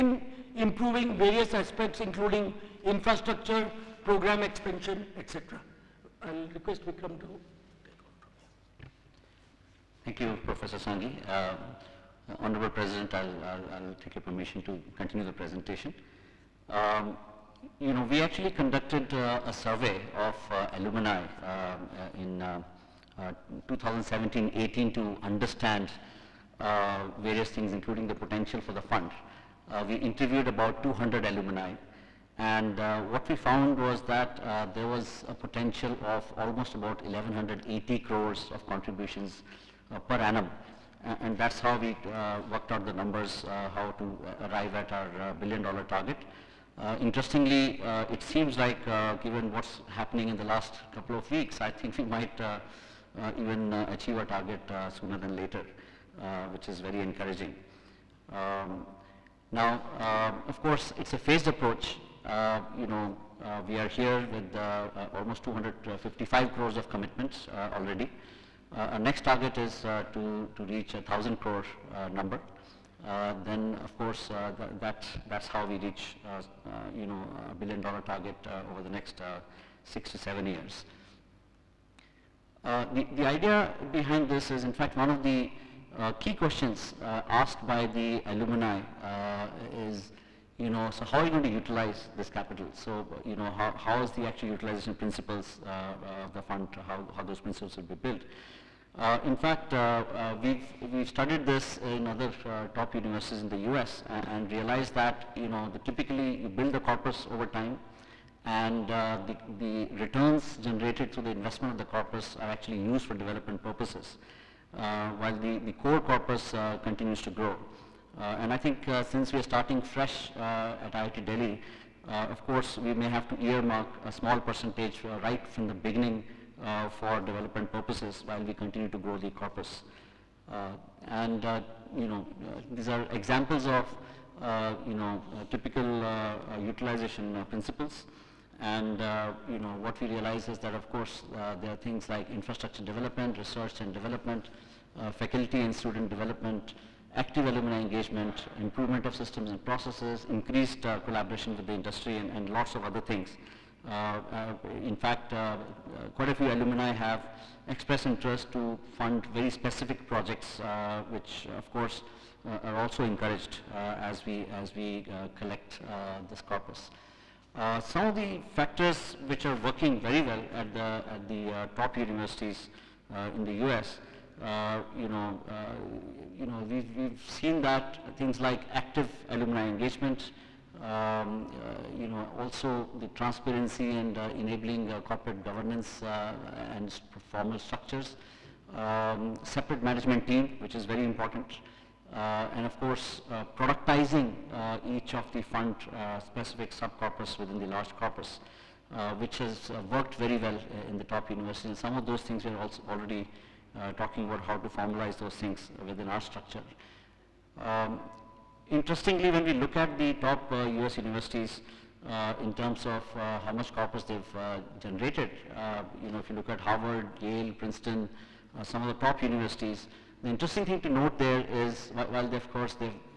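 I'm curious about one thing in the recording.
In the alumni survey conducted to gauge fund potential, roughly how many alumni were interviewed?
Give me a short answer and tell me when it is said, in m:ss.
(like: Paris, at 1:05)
200, at 0:30.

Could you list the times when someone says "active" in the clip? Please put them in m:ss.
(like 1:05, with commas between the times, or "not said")
2:27, 2:58.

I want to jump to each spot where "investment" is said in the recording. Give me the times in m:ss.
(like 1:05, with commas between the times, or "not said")
1:51.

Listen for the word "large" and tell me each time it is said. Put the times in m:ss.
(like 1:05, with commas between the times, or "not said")
3:17.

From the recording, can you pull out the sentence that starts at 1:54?
while the, the core corpus continues to grow.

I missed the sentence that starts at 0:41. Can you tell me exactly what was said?
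and that's how we uh, worked out the numbers, uh, how to uh, arrive at our billion dollar target.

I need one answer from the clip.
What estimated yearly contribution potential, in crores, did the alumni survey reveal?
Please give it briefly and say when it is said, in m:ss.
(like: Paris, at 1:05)
1180 crores, at 0:37.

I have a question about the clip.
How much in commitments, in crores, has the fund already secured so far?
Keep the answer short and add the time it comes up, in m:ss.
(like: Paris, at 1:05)
255 crores, at 1:05.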